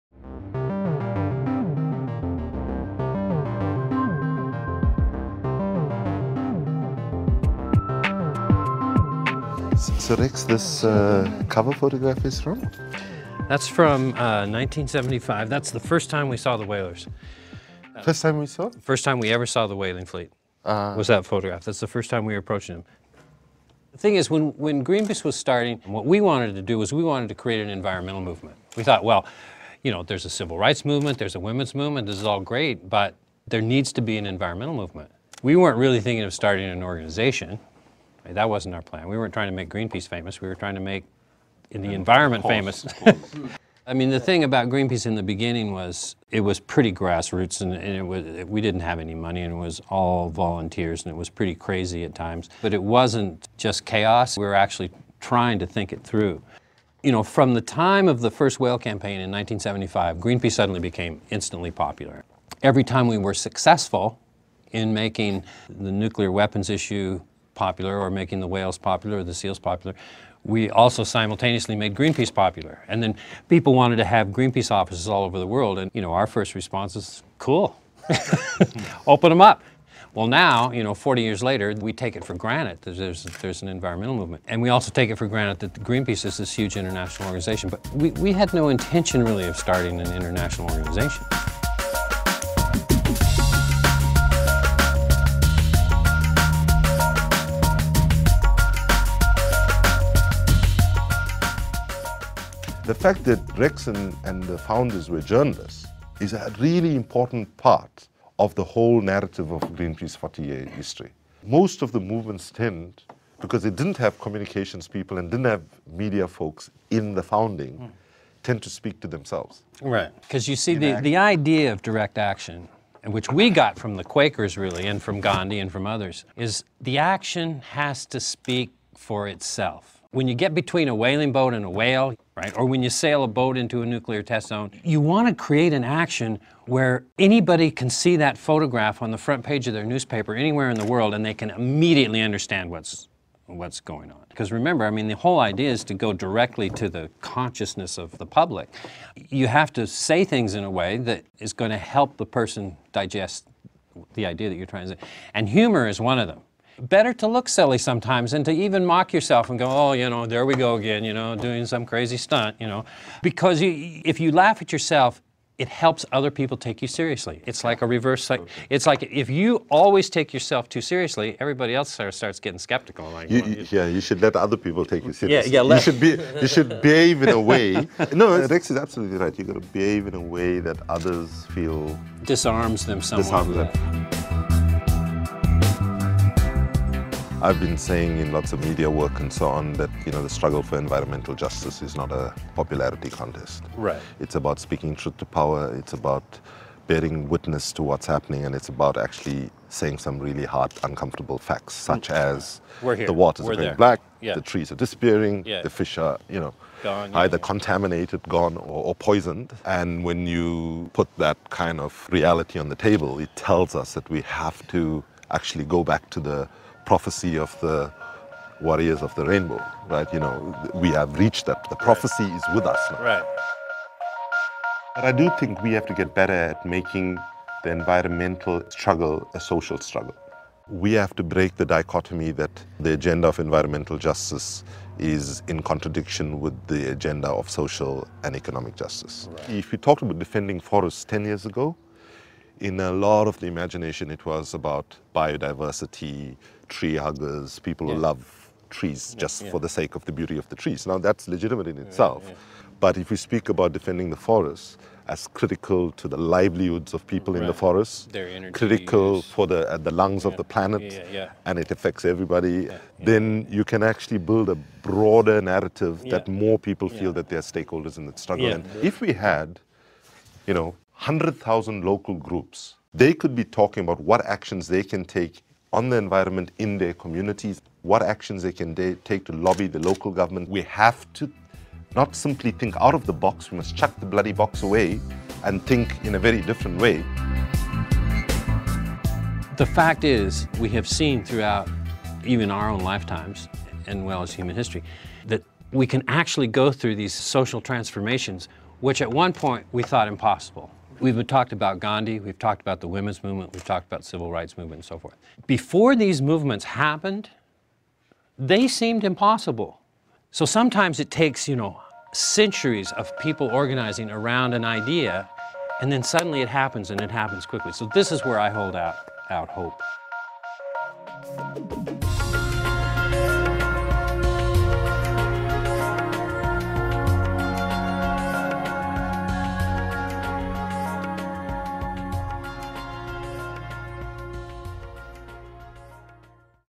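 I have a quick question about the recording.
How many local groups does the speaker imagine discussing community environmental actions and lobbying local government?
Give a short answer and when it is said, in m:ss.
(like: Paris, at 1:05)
100,000, at 4:31.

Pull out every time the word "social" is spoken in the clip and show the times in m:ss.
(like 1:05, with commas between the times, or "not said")
3:49, 3:57, 4:57.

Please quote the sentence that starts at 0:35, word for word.
We weren't really thinking of starting an organization.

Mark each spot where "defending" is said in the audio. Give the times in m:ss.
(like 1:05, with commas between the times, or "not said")
4:00, 4:13.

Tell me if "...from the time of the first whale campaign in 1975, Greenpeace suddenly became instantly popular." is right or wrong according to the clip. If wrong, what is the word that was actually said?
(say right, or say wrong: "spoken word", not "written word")
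right.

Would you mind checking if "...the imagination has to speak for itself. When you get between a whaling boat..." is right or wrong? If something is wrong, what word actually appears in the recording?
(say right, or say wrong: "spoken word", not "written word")
wrong: "action", not "imagination".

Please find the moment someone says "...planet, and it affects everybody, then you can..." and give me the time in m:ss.
4:20.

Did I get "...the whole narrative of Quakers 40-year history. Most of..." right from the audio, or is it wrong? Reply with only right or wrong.
wrong.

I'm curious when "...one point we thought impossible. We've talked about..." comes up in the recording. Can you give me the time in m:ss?
4:59.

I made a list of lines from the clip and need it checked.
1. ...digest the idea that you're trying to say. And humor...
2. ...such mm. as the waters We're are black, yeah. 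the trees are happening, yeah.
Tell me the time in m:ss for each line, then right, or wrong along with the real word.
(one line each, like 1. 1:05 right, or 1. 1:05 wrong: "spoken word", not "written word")
1. 2:32 right
2. 3:21 wrong: "disappearing", not "happening".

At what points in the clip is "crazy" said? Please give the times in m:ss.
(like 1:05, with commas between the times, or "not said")
0:51, 2:41.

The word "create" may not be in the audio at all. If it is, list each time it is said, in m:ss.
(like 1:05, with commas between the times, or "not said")
0:27, 2:15.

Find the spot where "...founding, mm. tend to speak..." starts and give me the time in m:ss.
1:57.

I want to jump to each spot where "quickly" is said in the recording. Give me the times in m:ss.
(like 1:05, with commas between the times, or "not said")
5:17.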